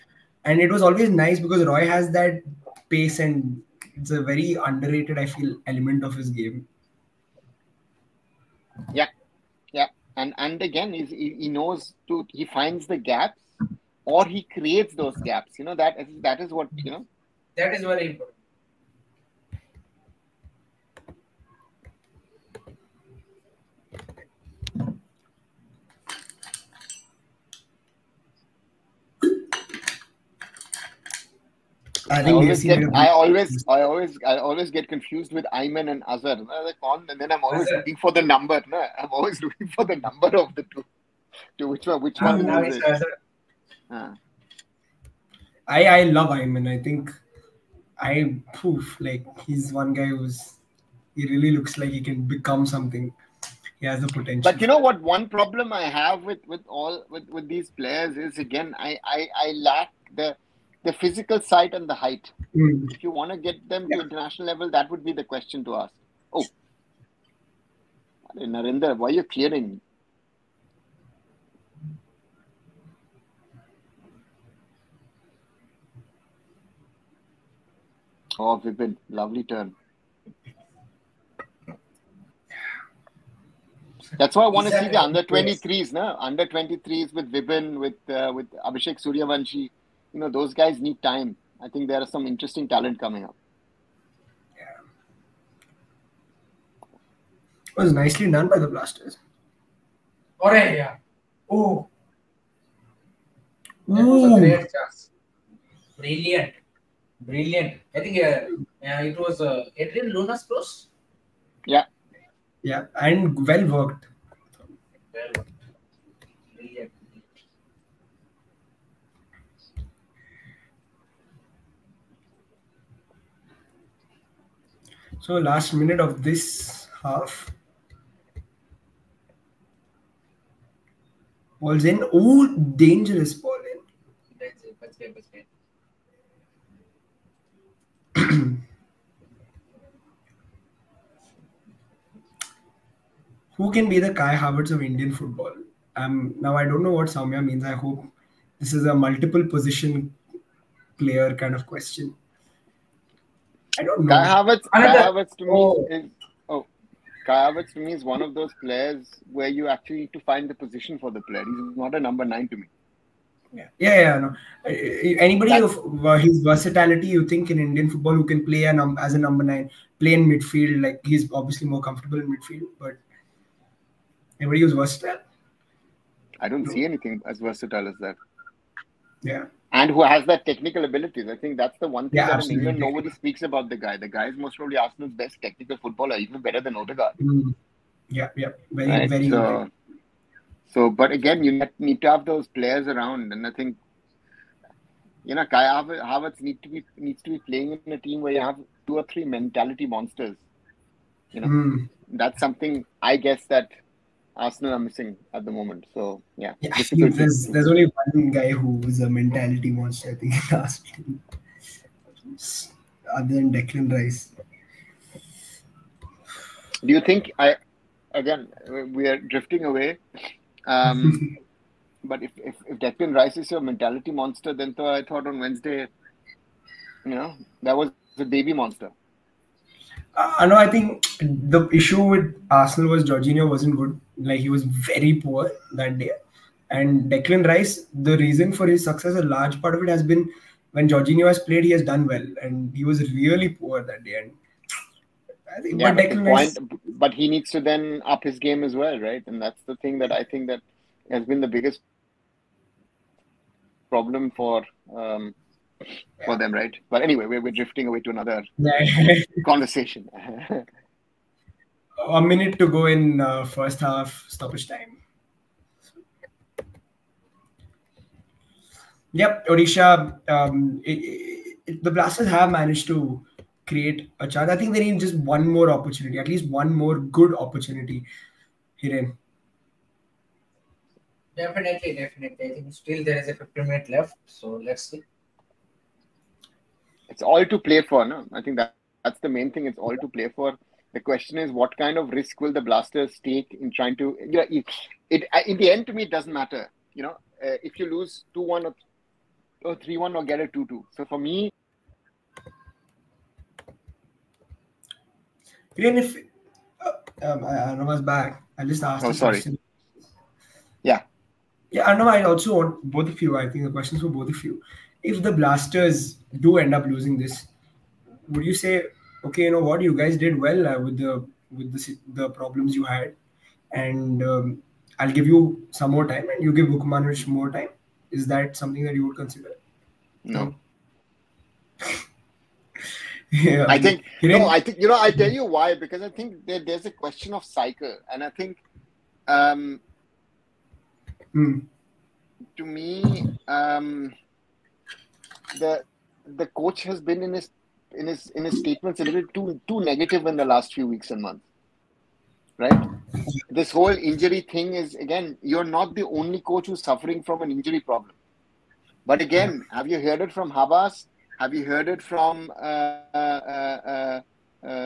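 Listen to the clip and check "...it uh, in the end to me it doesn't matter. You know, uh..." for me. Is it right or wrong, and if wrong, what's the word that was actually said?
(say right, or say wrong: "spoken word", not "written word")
right.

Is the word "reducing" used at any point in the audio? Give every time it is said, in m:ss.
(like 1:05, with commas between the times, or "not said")
not said.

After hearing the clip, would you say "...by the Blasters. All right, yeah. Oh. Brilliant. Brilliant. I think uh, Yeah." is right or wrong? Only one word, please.
right.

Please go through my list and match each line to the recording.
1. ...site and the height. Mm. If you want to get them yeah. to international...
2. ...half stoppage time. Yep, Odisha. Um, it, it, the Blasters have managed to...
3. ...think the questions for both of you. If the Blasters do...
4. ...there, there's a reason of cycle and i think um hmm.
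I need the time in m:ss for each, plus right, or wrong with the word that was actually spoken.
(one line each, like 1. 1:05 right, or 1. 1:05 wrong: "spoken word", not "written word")
1. 1:01 right
2. 4:23 right
3. 5:13 right
4. 5:36 wrong: "question", not "reason".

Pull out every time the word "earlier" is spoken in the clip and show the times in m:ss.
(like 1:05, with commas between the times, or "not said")
not said.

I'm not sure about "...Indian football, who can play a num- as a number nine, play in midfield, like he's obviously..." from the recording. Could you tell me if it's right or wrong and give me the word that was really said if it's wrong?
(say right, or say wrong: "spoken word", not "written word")
right.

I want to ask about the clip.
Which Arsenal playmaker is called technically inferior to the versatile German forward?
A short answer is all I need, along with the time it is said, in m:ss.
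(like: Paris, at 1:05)
Odegaard, at 3:06.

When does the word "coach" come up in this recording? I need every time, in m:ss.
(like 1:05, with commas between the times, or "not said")
5:46, 5:56.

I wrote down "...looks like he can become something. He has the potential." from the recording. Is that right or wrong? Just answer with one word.
right.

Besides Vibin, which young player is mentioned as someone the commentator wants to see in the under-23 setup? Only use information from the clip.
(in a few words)
Abhishek Suryavanshi.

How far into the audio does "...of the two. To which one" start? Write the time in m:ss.
0:40.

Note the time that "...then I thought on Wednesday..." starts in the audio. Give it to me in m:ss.
3:44.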